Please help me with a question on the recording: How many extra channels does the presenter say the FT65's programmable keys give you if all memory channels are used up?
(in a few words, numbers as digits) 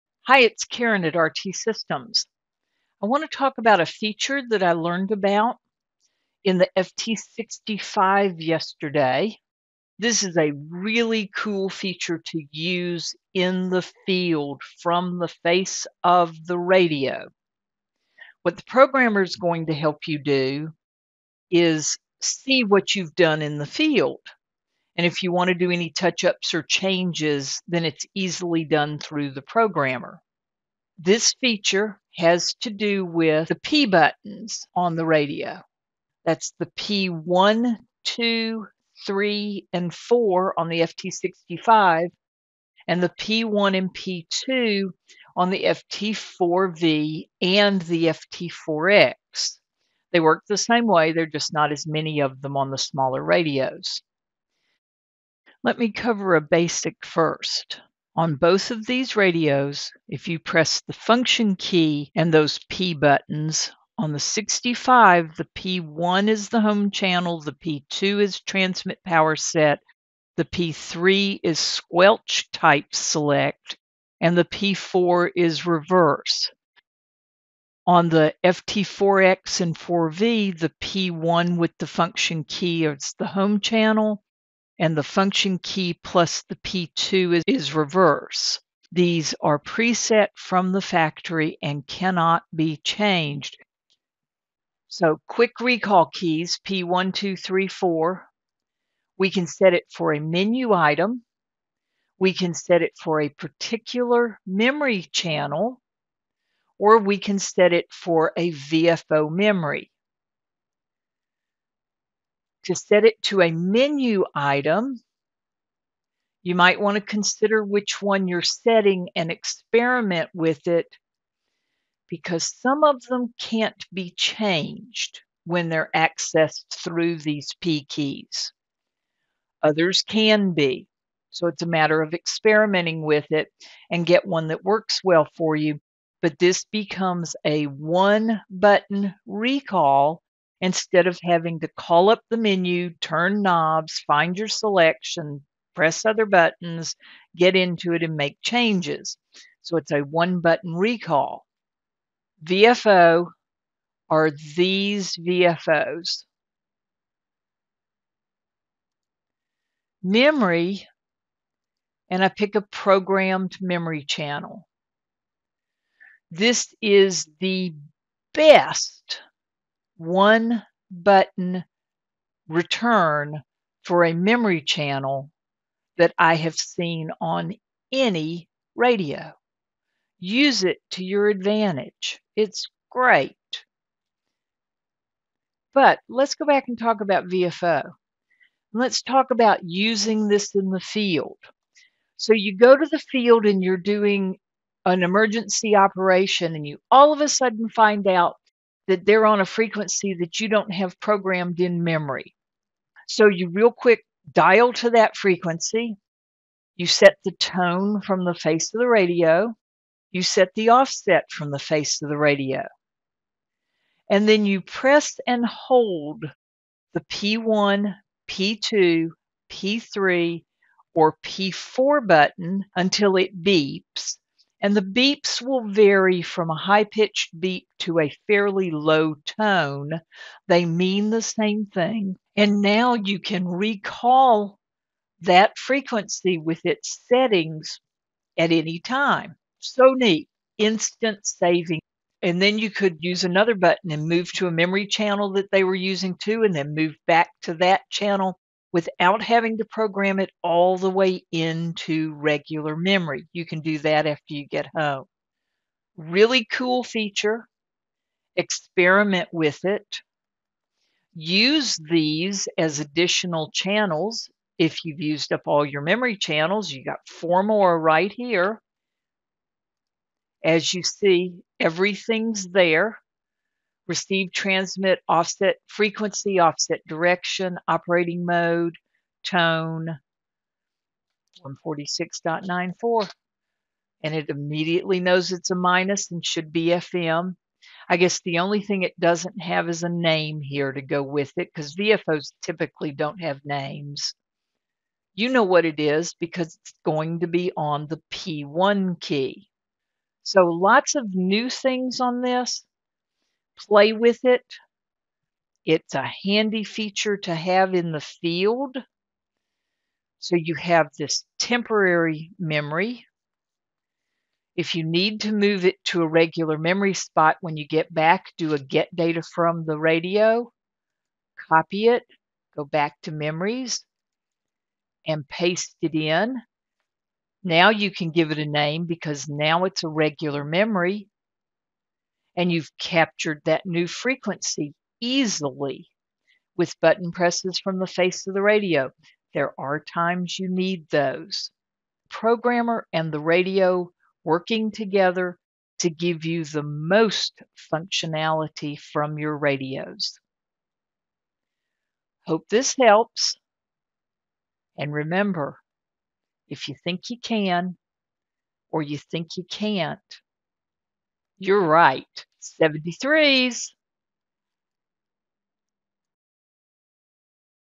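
4.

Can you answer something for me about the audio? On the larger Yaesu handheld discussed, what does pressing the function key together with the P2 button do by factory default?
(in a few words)
Transmit power set.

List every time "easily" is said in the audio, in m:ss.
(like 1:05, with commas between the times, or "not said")
0:28, 5:34.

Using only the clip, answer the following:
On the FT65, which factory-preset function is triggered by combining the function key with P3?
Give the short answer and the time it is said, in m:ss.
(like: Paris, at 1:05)
Squelch type select, at 1:11.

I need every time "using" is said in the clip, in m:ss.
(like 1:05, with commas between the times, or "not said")
3:09, 4:05.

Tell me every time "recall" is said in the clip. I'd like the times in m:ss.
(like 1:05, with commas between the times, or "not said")
1:35, 2:19, 2:30, 3:53.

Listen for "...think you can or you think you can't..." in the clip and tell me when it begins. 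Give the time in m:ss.
5:56.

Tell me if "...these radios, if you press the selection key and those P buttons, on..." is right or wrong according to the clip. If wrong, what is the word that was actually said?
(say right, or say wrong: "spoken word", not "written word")
wrong: "function", not "selection".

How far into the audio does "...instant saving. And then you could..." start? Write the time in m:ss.
4:00.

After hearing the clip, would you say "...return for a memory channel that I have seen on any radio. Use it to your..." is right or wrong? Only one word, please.
right.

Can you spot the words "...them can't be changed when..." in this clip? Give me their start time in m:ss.
2:03.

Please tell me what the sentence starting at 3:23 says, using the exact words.
So you real quick dial to that frequency.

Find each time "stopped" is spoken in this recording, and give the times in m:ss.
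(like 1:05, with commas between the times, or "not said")
not said.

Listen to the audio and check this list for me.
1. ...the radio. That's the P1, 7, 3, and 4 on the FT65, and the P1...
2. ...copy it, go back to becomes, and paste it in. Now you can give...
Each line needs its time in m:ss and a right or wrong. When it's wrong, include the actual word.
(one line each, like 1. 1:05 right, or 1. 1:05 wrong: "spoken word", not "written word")
1. 0:34 wrong: "2", not "7"
2. 5:21 wrong: "memories", not "becomes".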